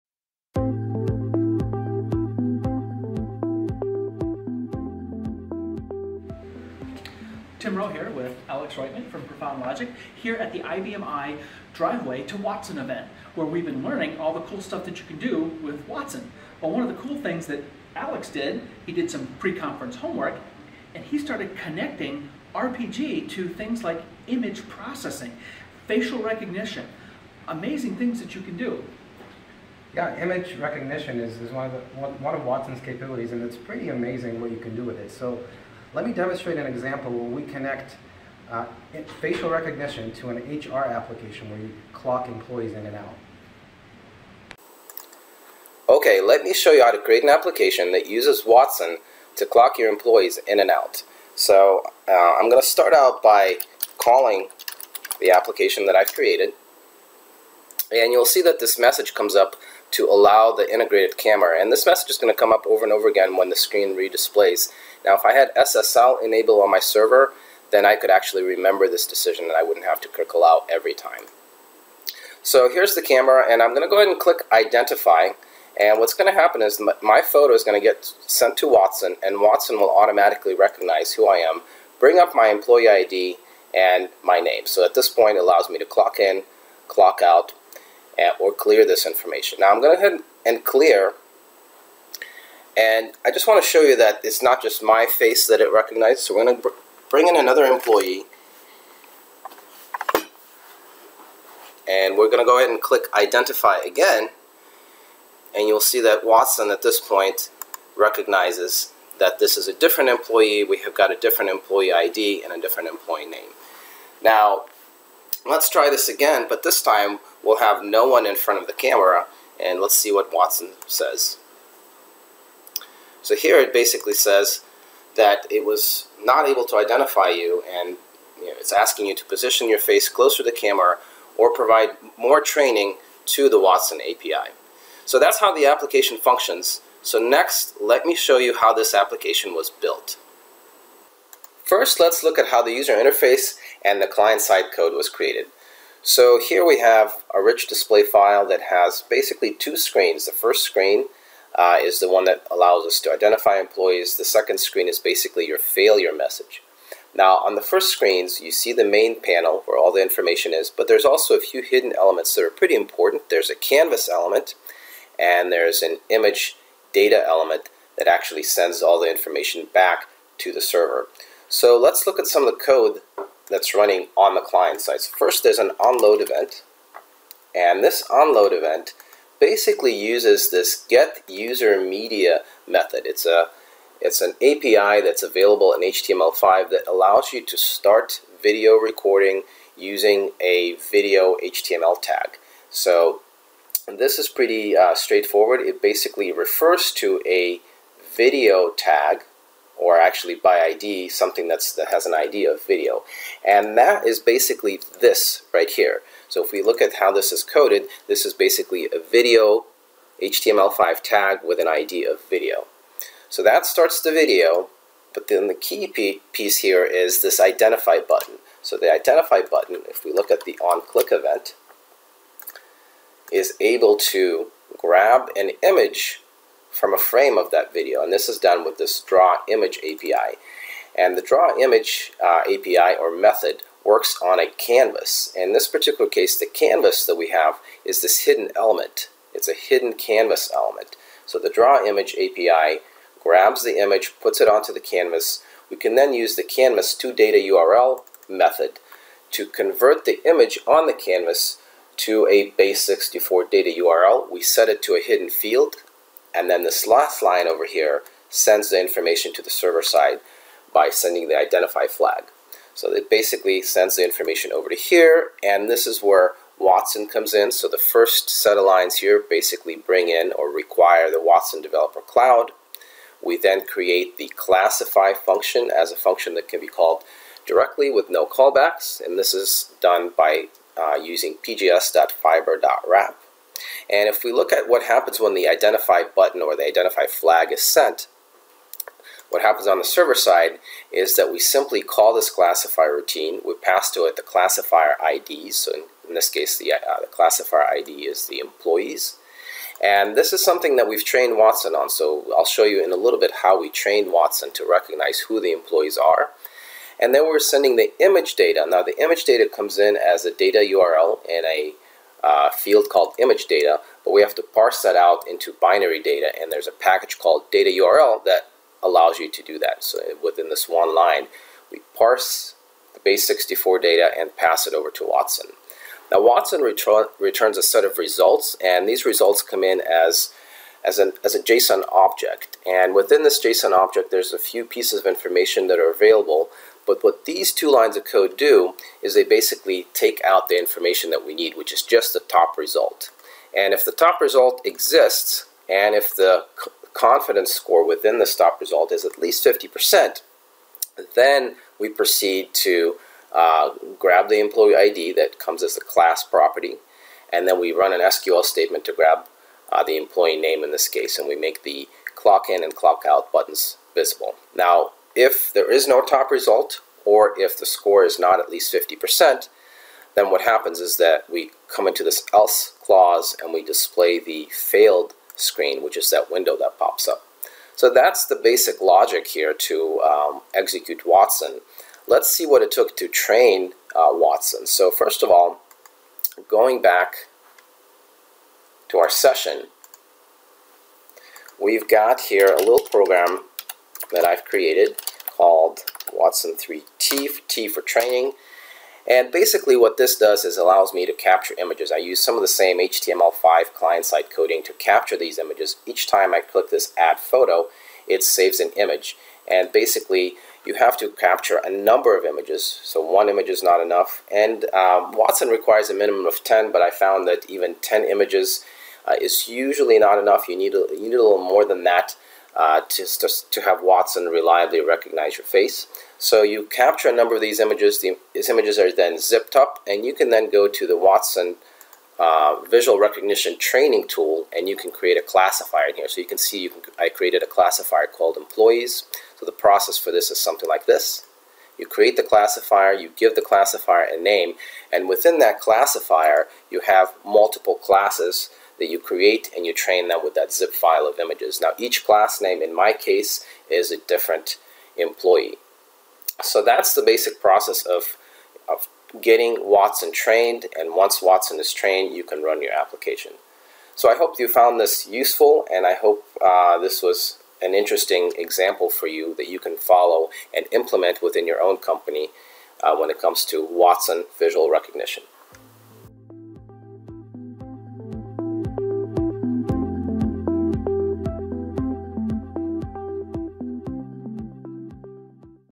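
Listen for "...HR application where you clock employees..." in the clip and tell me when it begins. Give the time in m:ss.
0:40.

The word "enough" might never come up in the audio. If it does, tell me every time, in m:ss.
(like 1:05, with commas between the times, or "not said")
6:53, 7:00.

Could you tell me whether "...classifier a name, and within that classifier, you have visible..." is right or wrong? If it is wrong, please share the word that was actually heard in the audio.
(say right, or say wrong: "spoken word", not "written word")
wrong: "multiple", not "visible".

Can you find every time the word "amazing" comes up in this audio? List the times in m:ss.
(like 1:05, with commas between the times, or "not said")
0:27, 0:33.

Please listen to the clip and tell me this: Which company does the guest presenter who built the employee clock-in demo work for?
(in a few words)
Profound Logic.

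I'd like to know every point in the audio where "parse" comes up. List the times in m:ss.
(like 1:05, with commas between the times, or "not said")
5:14, 5:21.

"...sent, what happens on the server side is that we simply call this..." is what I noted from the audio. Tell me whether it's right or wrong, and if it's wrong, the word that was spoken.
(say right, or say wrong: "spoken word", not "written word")
right.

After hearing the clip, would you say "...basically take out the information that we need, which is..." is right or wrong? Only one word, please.
right.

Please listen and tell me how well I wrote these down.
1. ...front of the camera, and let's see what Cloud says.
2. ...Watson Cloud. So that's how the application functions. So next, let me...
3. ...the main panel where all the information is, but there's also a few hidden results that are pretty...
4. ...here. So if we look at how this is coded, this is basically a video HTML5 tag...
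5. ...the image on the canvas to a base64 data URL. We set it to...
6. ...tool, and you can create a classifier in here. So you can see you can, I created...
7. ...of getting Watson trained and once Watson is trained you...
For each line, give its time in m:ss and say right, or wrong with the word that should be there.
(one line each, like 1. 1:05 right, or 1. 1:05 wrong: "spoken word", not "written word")
1. 1:58 wrong: "Watson", not "Cloud"
2. 2:13 wrong: "API", not "Cloud"
3. 2:38 wrong: "elements", not "results"
4. 3:25 right
5. 4:10 right
6. 7:14 right
7. 7:38 right.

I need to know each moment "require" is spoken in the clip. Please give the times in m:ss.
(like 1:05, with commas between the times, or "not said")
4:30, 6:55.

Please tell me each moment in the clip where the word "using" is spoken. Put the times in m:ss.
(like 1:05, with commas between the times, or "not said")
3:09, 4:40.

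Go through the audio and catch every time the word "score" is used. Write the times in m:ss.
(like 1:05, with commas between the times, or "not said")
5:47, 6:07.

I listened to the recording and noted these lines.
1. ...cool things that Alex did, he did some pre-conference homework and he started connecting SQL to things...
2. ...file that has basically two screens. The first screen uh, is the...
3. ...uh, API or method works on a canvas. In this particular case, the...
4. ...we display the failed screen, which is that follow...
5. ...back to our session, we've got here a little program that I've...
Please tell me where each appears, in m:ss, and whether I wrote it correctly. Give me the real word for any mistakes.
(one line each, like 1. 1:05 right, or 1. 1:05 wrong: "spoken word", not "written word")
1. 0:16 wrong: "RPG", not "SQL"
2. 2:28 right
3. 3:52 right
4. 6:13 wrong: "window", not "follow"
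5. 6:26 right.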